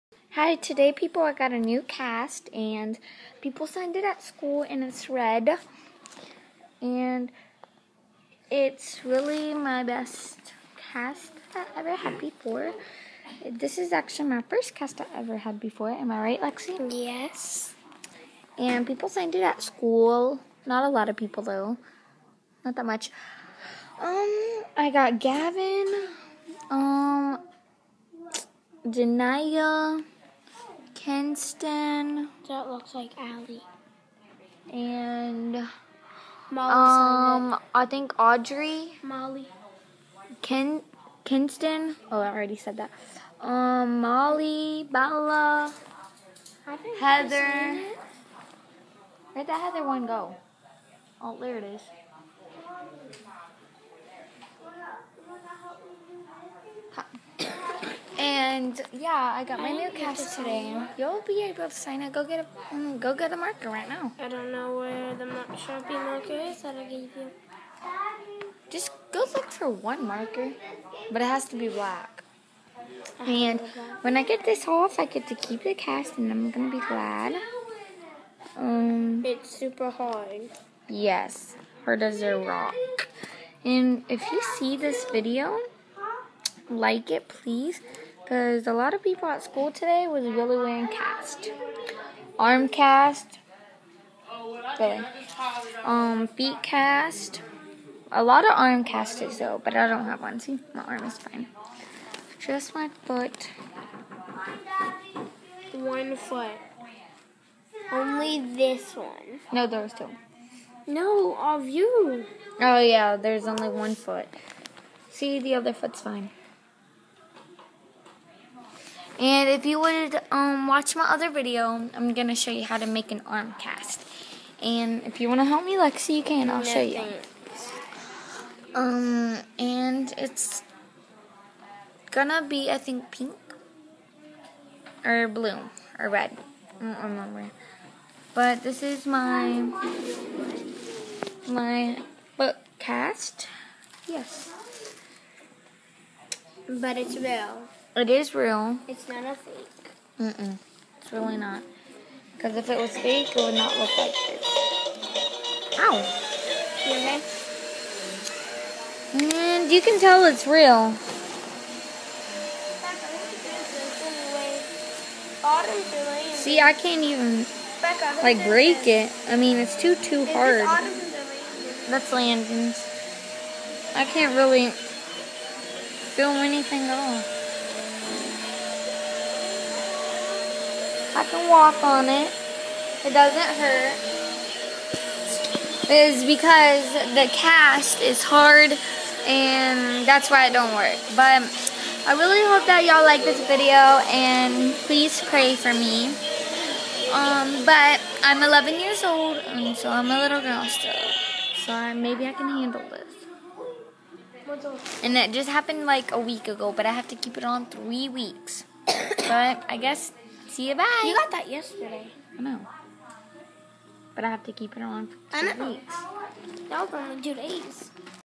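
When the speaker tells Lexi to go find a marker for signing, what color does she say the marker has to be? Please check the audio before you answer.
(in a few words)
black.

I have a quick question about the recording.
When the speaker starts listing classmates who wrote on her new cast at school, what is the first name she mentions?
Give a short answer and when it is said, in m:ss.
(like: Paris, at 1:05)
Gavin, at 0:25.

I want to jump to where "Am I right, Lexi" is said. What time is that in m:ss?
0:15.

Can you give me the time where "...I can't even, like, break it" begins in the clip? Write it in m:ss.
2:46.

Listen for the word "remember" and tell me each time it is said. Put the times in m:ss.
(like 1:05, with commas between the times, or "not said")
2:17.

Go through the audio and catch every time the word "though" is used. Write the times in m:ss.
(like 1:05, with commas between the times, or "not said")
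0:21, 1:39.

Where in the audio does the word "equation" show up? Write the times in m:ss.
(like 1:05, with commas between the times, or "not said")
not said.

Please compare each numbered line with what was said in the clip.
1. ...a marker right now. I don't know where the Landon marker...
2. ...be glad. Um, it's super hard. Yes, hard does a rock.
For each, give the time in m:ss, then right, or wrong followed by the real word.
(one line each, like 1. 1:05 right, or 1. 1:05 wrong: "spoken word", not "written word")
1. 1:03 wrong: "Sharpie", not "Landon"
2. 1:16 right.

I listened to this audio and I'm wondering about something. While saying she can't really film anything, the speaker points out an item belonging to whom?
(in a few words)
Landon.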